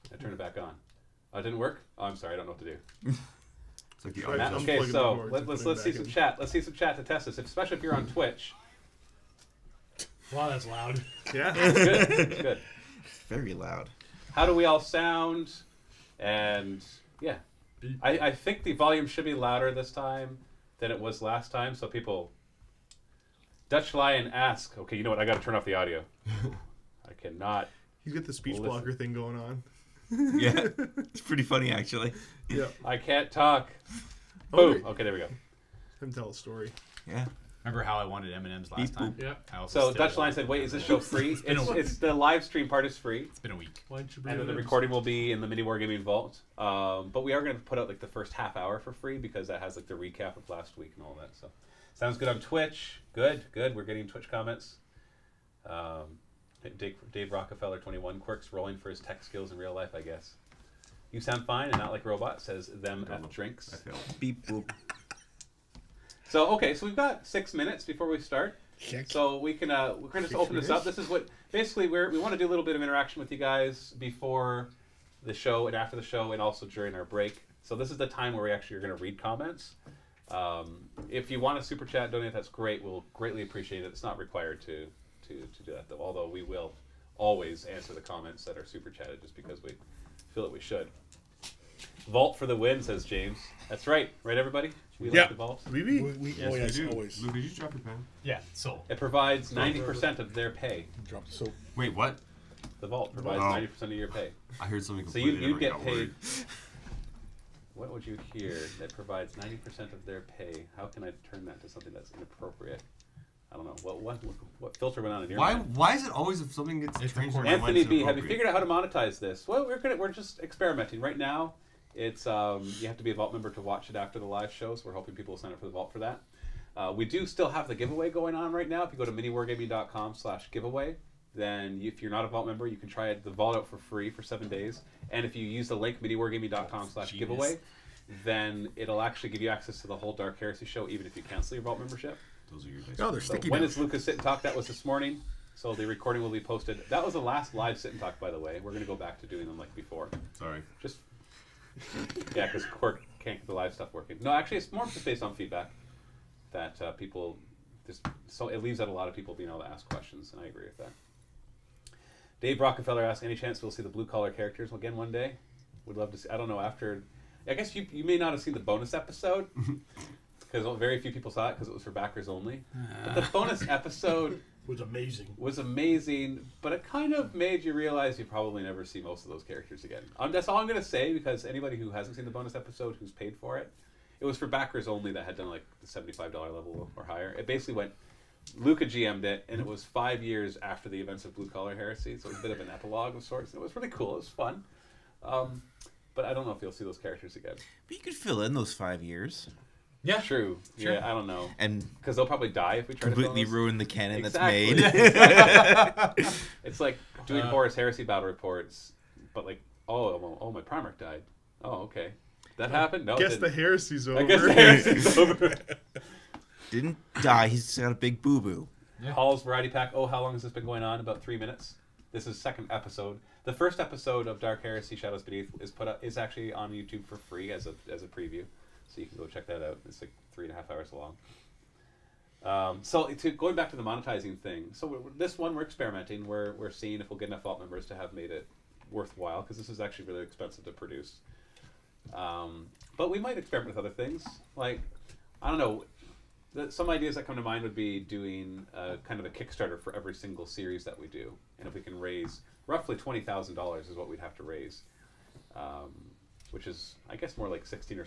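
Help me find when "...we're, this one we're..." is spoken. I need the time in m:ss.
3:54.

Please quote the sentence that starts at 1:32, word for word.
Vault for the win, says James.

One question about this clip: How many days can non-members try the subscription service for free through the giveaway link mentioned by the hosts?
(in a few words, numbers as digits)
7.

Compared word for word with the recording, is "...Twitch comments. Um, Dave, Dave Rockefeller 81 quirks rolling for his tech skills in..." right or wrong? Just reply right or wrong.
wrong.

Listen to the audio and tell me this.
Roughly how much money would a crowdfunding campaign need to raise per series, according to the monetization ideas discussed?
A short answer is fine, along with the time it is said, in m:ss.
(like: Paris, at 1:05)
$20,000, at 4:12.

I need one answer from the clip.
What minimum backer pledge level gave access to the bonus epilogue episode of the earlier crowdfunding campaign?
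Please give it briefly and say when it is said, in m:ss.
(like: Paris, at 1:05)
$75, at 3:05.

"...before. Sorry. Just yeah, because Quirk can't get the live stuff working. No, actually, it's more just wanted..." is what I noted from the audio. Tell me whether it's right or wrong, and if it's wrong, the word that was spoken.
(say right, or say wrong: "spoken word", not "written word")
wrong: "based", not "wanted".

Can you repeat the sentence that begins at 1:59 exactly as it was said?
Well, we're gonna, we're just experimenting right now.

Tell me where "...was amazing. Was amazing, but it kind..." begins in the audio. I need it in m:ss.
2:54.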